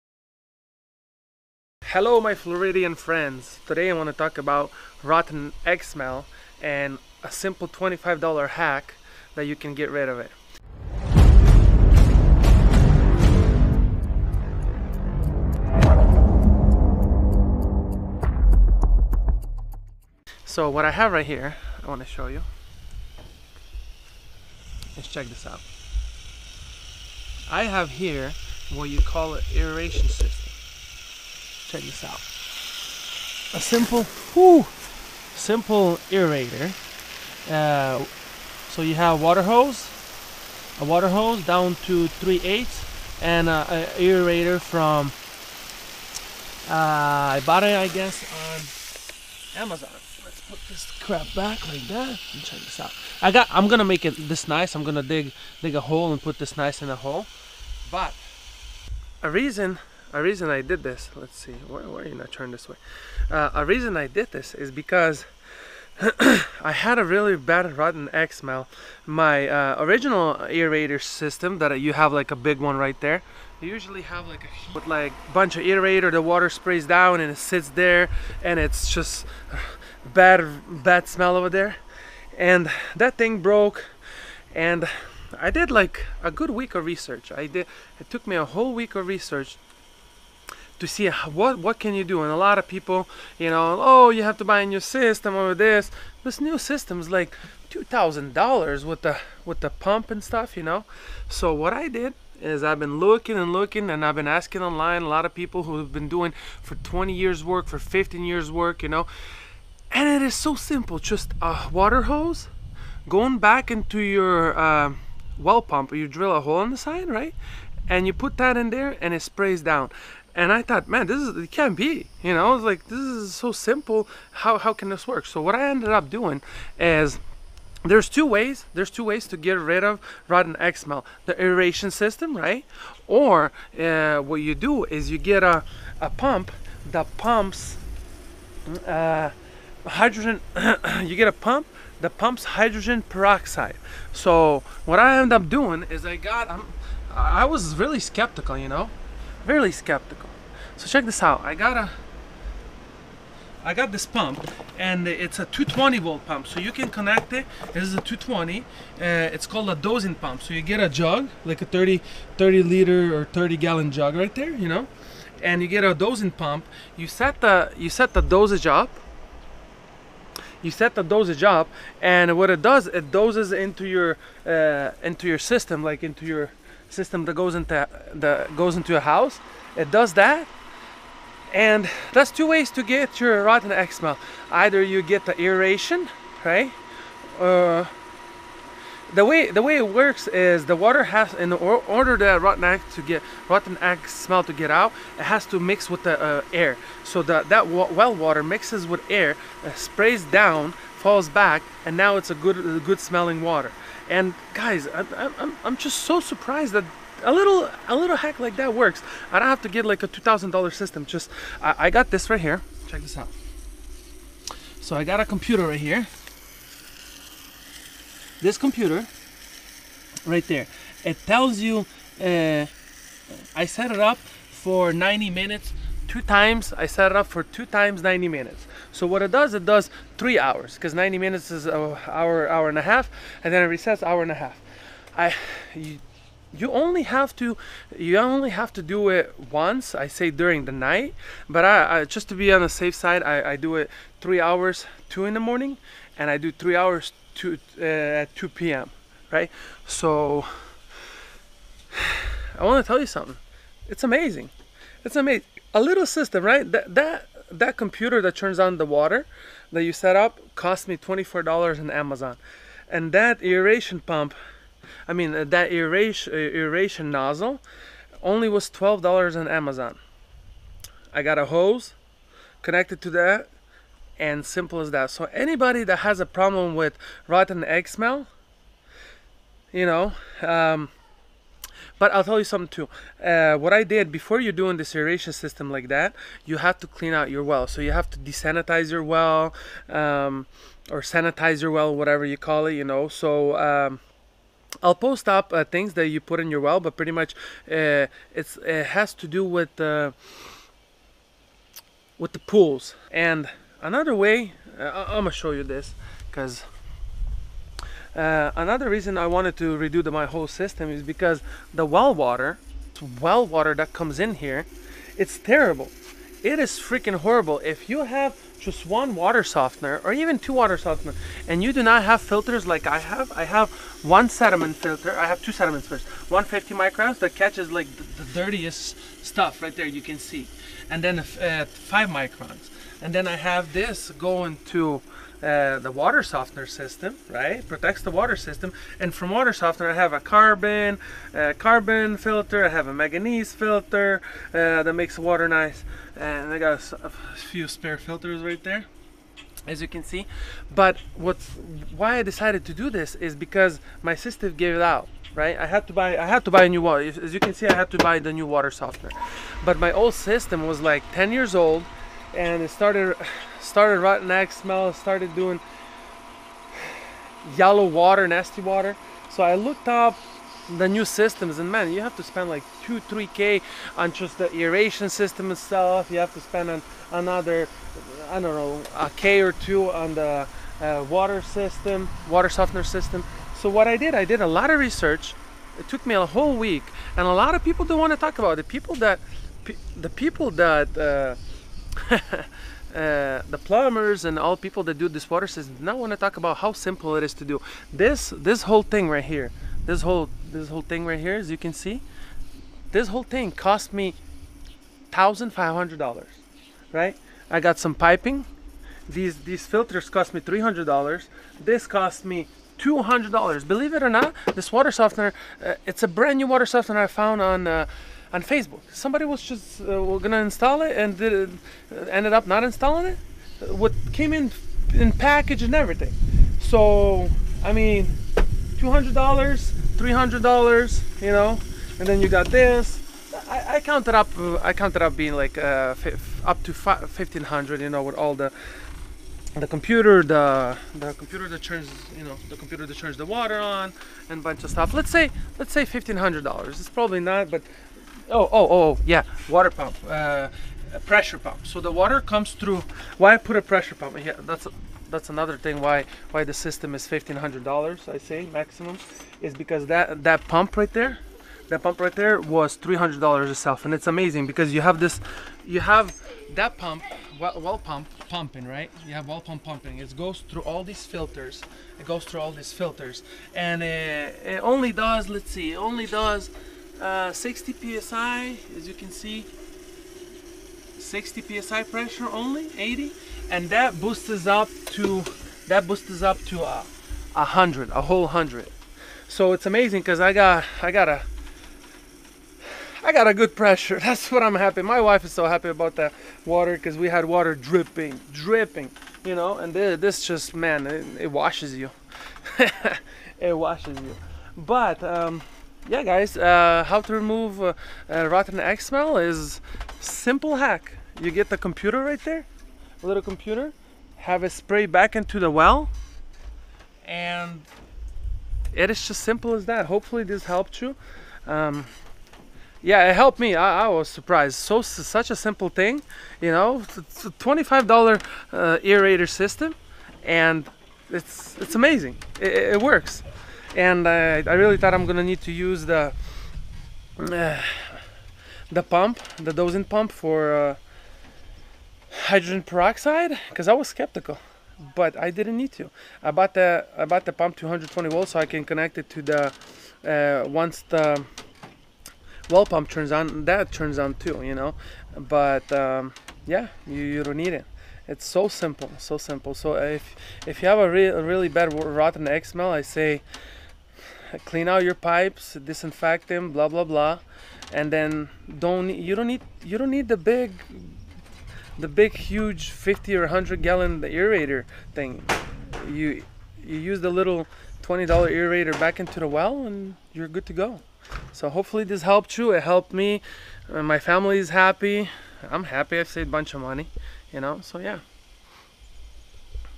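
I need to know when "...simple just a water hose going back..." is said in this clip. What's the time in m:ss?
1:50.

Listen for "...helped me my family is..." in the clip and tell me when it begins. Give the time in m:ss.
9:42.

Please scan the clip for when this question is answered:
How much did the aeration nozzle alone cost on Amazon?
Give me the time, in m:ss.
4:28.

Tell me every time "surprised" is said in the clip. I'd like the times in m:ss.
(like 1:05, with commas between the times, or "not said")
3:26, 8:44.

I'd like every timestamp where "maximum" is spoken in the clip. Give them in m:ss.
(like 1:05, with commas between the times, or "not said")
7:38.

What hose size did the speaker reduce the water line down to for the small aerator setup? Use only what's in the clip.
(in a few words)
3/8.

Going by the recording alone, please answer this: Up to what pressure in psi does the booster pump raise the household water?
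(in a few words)
100 psi.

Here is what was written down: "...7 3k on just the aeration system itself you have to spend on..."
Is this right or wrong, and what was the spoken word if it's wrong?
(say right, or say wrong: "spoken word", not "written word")
wrong: "2", not "7".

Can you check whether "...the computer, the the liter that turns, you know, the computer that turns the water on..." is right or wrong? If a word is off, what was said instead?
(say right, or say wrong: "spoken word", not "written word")
wrong: "computer", not "liter".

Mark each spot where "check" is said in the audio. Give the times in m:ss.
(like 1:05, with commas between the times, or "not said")
0:25, 0:31, 0:52, 2:30, 3:32.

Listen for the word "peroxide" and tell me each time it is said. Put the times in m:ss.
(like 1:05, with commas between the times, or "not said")
2:23, 9:02.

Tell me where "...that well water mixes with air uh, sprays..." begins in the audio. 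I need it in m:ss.
3:17.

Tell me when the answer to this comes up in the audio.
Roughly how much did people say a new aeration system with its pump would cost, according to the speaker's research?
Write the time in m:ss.
1:37.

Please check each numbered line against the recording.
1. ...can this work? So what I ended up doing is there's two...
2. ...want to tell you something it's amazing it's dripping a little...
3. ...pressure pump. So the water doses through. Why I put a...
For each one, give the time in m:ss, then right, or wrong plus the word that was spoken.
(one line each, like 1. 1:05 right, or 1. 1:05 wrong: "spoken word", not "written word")
1. 2:04 right
2. 4:12 wrong: "amazing", not "dripping"
3. 7:31 wrong: "comes", not "doses".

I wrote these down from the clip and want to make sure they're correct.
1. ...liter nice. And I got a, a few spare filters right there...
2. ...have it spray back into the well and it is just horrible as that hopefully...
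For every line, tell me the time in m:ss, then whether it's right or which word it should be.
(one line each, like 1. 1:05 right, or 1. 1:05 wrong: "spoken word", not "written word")
1. 5:45 wrong: "water", not "liter"
2. 8:34 wrong: "simple", not "horrible".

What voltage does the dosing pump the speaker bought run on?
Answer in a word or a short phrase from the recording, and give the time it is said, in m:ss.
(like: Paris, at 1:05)
220 volts, at 2:35.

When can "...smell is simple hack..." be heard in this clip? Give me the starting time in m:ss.
8:28.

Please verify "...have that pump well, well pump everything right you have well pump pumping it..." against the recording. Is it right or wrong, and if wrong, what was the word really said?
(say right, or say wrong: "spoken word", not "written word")
wrong: "pumping", not "everything".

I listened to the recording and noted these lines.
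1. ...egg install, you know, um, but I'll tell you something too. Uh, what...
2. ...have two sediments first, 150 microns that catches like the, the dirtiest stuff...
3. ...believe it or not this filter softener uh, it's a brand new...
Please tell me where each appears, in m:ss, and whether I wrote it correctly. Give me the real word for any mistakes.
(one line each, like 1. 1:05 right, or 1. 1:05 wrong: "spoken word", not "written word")
1. 4:37 wrong: "smell", not "install"
2. 5:25 right
3. 6:53 wrong: "water", not "filter".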